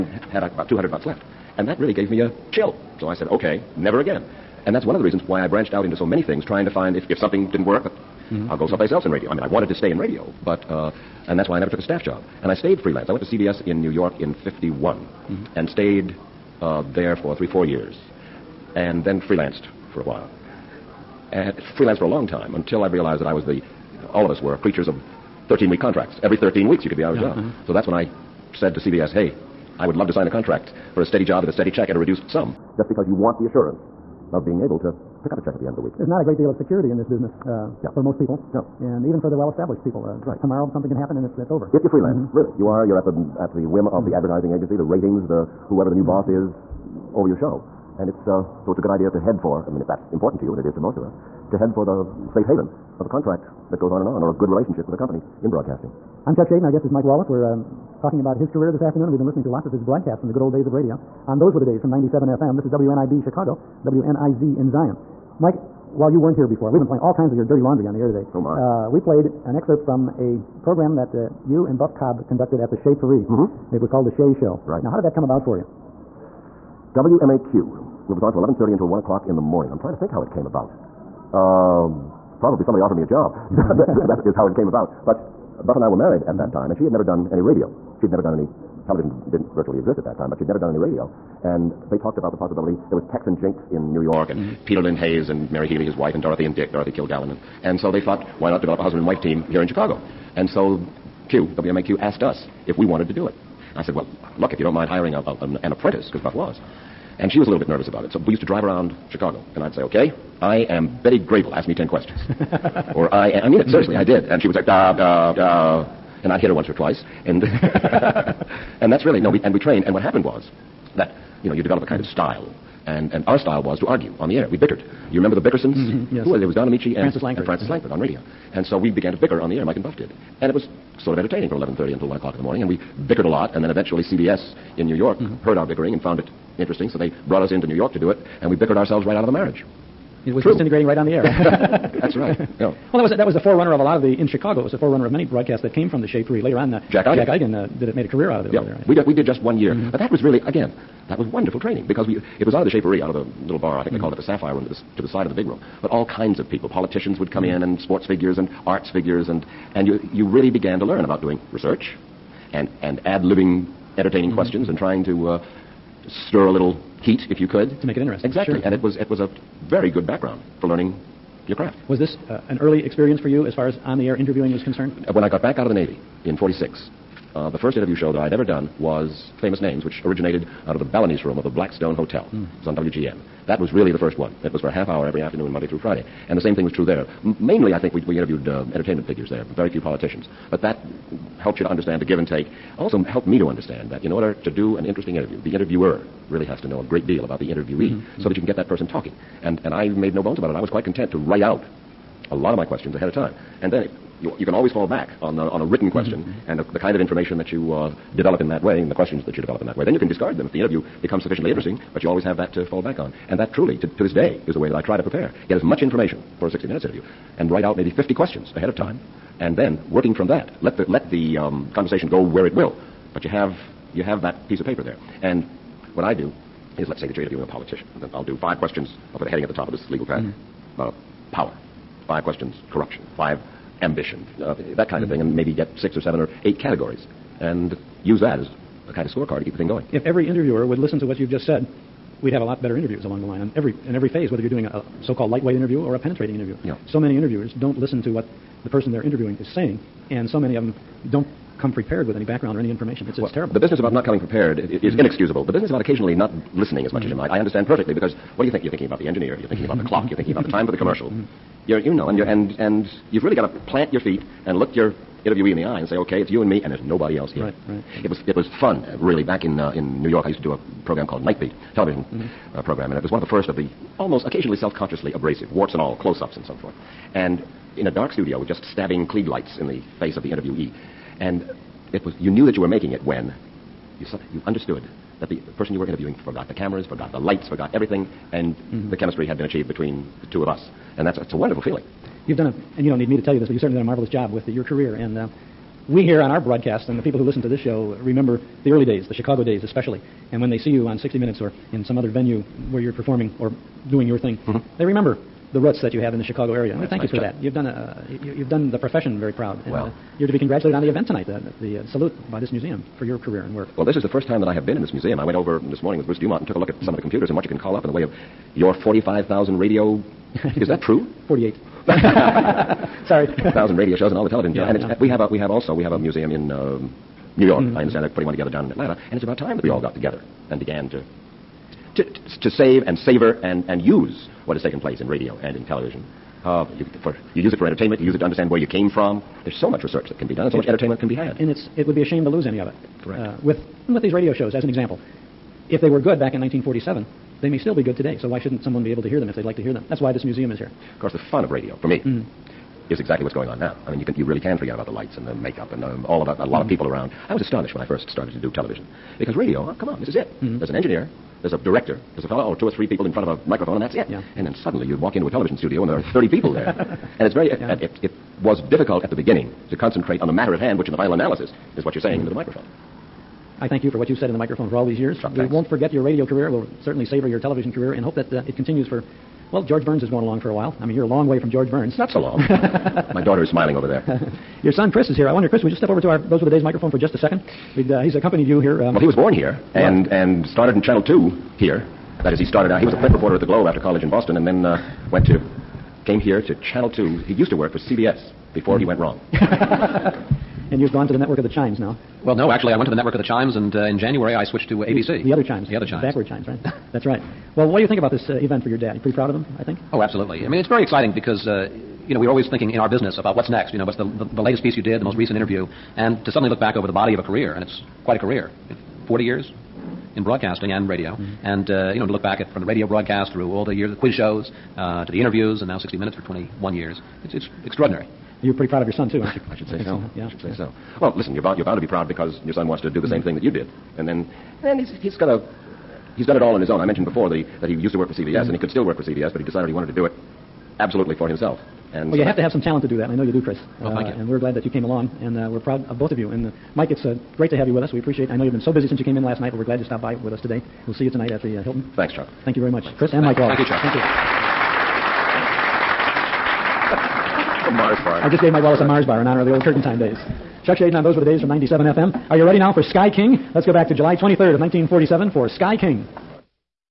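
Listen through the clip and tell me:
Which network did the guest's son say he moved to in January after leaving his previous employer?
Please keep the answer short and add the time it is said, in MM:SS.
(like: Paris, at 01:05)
ABC, at 06:44.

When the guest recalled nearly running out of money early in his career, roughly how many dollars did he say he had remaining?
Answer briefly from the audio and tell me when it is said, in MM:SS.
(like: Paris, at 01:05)
200, at 00:00.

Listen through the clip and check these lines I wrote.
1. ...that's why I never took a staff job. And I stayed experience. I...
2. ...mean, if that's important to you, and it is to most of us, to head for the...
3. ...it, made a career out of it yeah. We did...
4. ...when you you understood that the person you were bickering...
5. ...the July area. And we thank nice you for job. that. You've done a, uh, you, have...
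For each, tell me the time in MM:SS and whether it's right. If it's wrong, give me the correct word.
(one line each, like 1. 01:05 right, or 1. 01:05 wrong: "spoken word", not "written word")
1. 00:11 wrong: "freelance", not "experience"
2. 00:49 right
3. 02:27 right
4. 04:43 wrong: "interviewing", not "bickering"
5. 05:06 wrong: "Chicago", not "July".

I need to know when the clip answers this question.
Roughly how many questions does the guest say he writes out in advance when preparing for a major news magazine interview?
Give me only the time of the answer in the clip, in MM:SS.
03:37.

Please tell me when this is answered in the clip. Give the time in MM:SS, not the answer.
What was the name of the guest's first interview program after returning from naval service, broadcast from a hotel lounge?
02:59.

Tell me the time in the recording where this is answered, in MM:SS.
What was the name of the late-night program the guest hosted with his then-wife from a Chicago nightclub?
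01:14.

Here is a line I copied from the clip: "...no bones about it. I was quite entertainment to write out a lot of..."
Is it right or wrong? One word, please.
wrong.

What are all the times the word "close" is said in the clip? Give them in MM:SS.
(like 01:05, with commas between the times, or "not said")
04:35.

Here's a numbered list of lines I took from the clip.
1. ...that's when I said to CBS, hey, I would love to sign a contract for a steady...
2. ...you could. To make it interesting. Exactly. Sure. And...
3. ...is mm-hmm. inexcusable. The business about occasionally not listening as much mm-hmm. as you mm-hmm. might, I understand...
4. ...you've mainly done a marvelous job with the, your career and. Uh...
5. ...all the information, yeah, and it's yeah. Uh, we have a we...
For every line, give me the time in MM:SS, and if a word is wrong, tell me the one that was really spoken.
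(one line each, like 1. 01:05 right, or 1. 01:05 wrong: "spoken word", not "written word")
1. 00:27 right
2. 02:47 right
3. 04:14 right
4. 04:53 wrong: "certainly", not "mainly"
5. 05:24 wrong: "television", not "information".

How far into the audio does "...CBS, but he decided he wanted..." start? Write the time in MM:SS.
07:19.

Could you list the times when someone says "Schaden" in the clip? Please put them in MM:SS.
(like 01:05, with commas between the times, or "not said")
00:56, 07:40.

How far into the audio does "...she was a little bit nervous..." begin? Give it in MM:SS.
01:47.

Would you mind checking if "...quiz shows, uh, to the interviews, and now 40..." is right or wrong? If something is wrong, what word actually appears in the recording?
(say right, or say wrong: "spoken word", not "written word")
wrong: "60", not "40".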